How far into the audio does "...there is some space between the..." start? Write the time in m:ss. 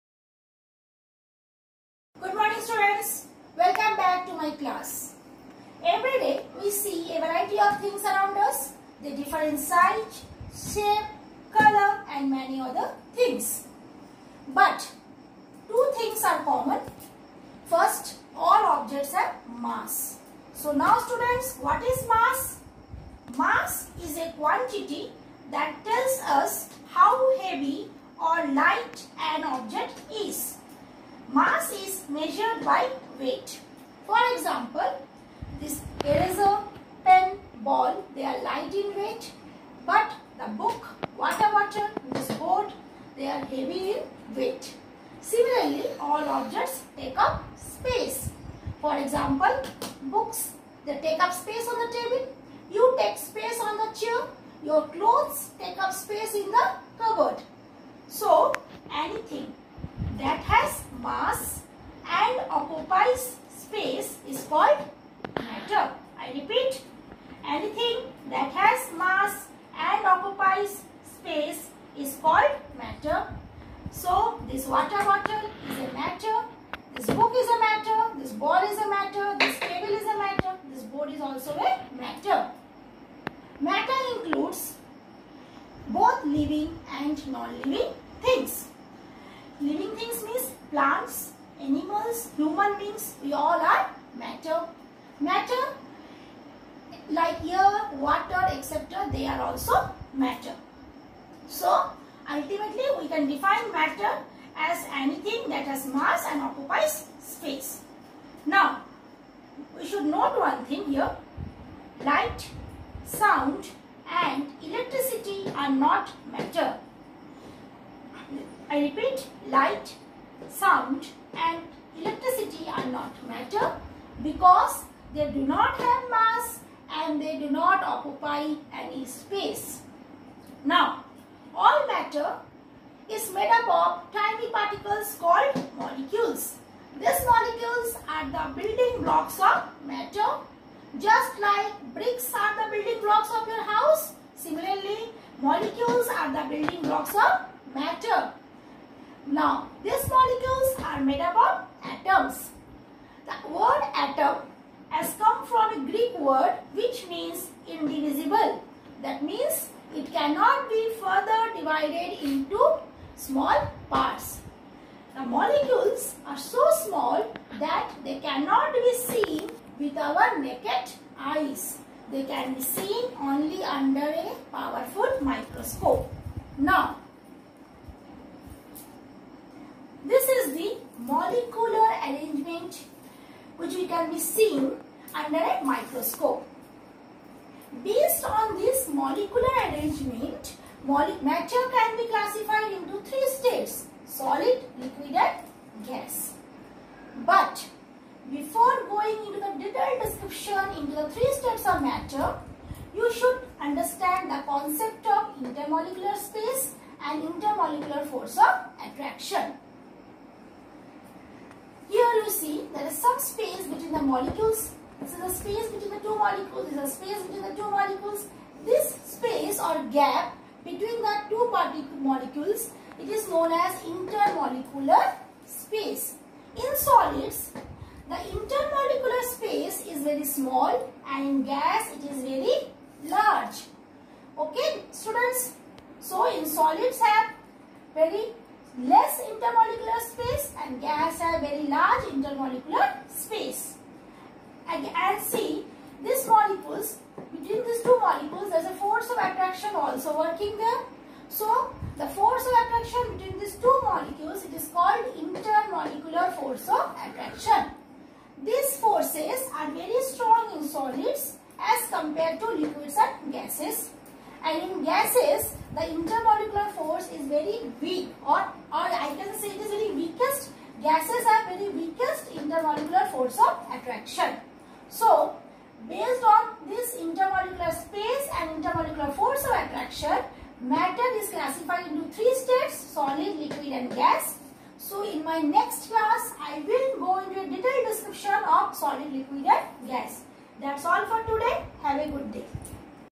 3:32.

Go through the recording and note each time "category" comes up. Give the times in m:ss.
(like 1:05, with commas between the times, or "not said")
not said.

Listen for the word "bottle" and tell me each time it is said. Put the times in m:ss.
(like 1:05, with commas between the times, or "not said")
0:41, 1:15.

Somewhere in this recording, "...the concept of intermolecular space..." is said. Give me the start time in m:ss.
3:24.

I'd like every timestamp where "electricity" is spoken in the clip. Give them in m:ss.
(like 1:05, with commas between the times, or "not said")
1:54, 2:02.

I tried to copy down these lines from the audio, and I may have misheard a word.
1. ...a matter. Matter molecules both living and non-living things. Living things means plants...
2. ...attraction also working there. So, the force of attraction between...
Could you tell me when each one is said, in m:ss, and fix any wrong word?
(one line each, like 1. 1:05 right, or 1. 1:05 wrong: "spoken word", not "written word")
1. 1:21 wrong: "includes", not "molecules"
2. 4:09 right.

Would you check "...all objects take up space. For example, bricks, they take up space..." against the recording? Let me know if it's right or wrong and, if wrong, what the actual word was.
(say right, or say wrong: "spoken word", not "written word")
wrong: "books", not "bricks".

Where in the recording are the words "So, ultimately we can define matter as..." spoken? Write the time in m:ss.
1:41.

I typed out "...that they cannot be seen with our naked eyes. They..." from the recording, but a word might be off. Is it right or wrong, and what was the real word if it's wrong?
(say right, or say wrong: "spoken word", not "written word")
right.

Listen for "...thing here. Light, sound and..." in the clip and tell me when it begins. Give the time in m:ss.
1:50.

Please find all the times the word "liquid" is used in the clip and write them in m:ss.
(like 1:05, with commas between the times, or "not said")
3:14, 4:22, 4:43, 4:49.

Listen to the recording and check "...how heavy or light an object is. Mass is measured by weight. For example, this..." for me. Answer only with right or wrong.
right.